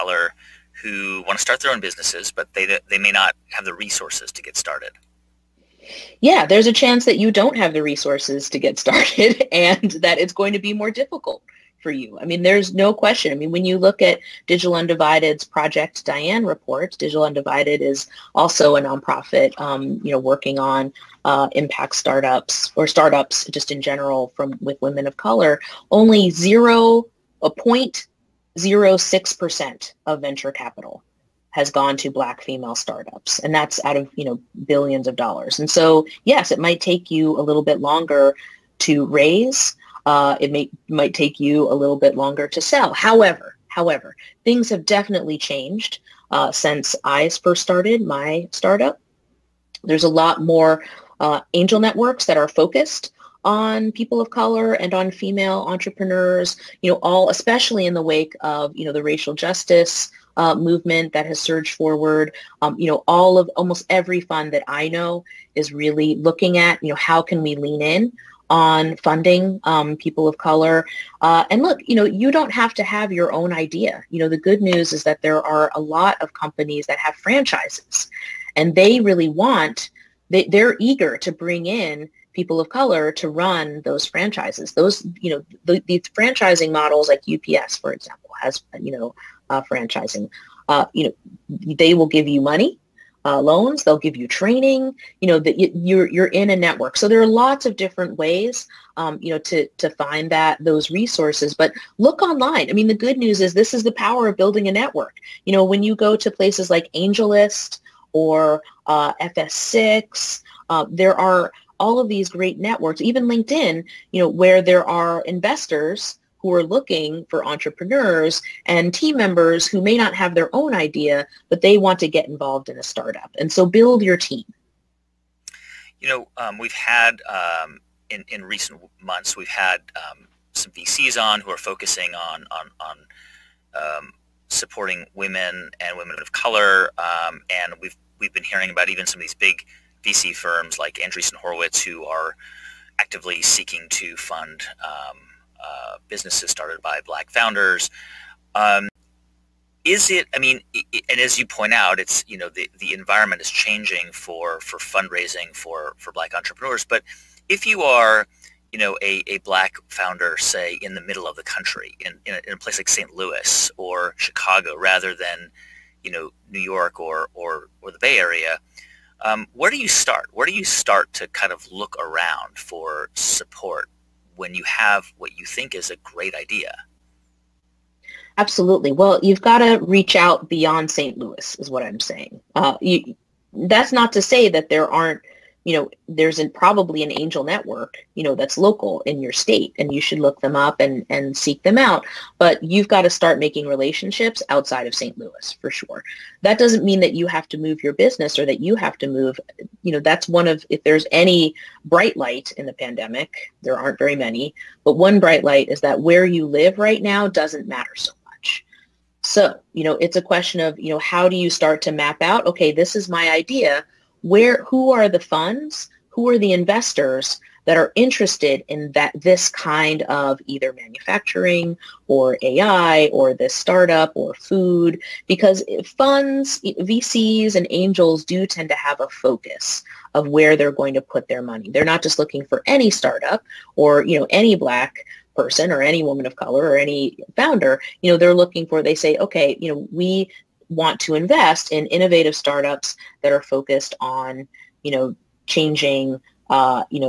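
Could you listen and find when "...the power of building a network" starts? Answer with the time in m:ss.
1:43.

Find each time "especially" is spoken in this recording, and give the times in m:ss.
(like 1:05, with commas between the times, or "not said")
0:57.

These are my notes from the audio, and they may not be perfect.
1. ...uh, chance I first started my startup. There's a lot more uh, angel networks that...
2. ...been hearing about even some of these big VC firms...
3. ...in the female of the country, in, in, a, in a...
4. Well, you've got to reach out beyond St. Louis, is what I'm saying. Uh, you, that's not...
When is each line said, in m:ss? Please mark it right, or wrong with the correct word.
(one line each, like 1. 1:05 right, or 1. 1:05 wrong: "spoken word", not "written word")
1. 0:46 wrong: "since", not "chance"
2. 2:18 right
3. 2:40 wrong: "middle", not "female"
4. 2:58 right.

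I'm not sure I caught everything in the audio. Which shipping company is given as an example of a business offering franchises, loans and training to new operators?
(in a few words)
UPS.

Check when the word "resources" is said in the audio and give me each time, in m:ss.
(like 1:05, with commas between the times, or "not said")
0:03, 0:07, 1:40.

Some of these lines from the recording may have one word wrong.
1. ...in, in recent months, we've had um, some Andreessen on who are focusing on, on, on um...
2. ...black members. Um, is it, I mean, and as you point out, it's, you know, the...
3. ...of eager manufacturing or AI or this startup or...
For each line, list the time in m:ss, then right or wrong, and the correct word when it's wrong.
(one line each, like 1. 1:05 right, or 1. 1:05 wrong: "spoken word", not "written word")
1. 2:08 wrong: "VCs", not "Andreessen"
2. 2:27 wrong: "founders", not "members"
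3. 3:40 wrong: "either", not "eager".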